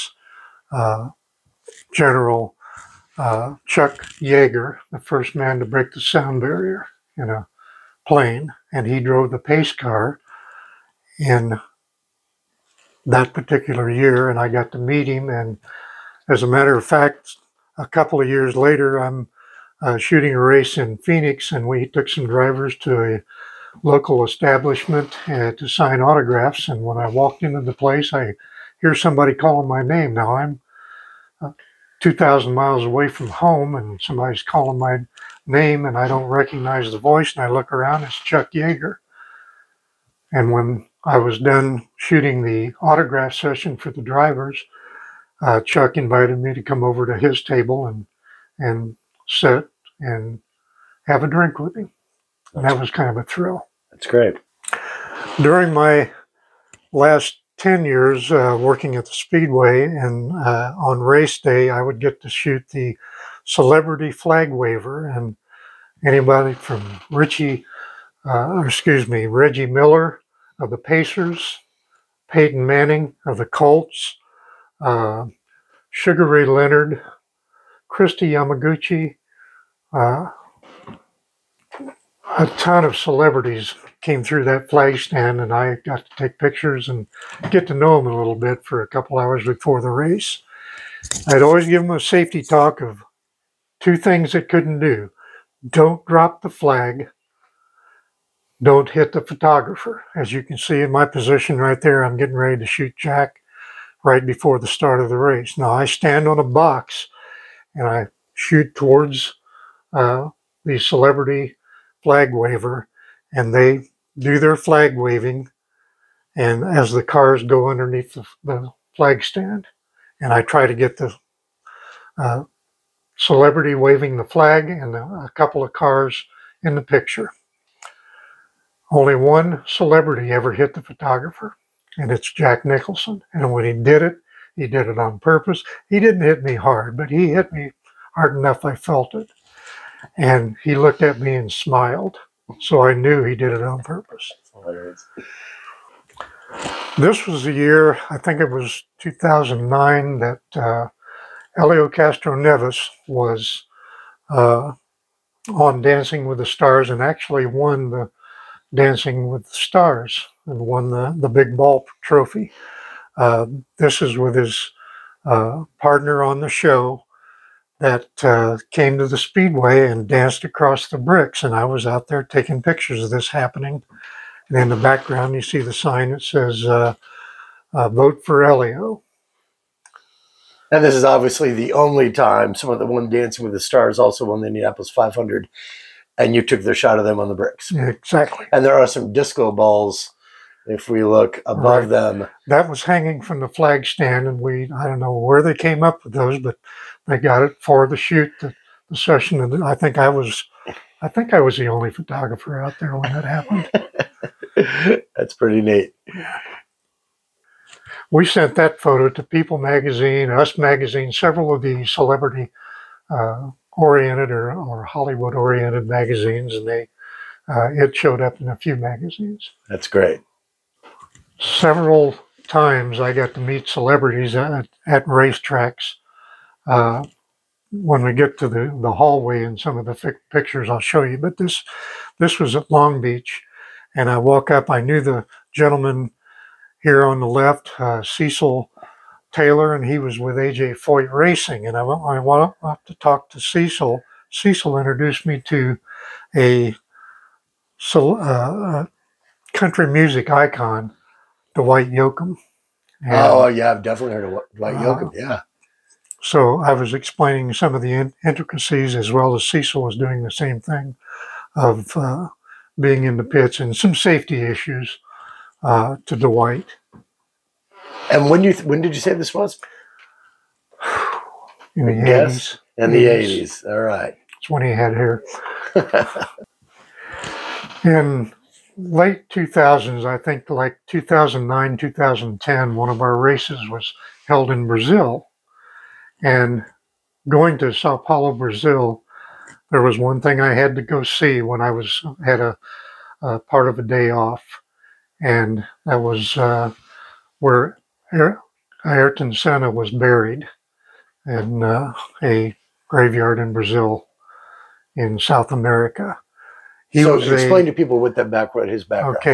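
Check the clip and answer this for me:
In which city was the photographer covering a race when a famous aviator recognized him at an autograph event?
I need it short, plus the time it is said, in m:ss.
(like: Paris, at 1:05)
Phoenix, at 0:20.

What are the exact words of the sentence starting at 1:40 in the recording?
As you can see in my position right there, I'm getting ready to shoot Jack right before the start of the race.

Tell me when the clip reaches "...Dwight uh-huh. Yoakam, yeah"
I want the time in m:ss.
4:14.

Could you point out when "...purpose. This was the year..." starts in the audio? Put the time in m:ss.
2:23.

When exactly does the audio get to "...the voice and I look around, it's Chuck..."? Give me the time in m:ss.
0:36.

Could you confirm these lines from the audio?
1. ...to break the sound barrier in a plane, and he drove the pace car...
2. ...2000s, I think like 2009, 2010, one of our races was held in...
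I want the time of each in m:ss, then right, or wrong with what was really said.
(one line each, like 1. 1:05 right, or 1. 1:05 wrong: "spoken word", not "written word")
1. 0:05 right
2. 4:39 right.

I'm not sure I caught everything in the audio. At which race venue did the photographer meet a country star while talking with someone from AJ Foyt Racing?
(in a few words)
Long Beach.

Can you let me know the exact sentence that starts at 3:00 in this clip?
And this is obviously the only time someone that won Dancing with the Stars also won the Indianapolis 500.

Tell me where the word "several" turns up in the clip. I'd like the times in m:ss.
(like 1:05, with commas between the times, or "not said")
3:31, 3:41.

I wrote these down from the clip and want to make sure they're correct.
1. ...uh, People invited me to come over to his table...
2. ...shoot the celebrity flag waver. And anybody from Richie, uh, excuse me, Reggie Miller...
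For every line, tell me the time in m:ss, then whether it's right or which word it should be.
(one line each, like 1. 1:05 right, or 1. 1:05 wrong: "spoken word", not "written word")
1. 0:45 wrong: "Chuck", not "People"
2. 1:02 right.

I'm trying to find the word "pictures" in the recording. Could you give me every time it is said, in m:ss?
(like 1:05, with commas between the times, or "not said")
1:26, 2:06, 2:52, 3:50.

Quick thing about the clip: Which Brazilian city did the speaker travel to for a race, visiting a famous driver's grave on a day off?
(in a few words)
Sao Paulo.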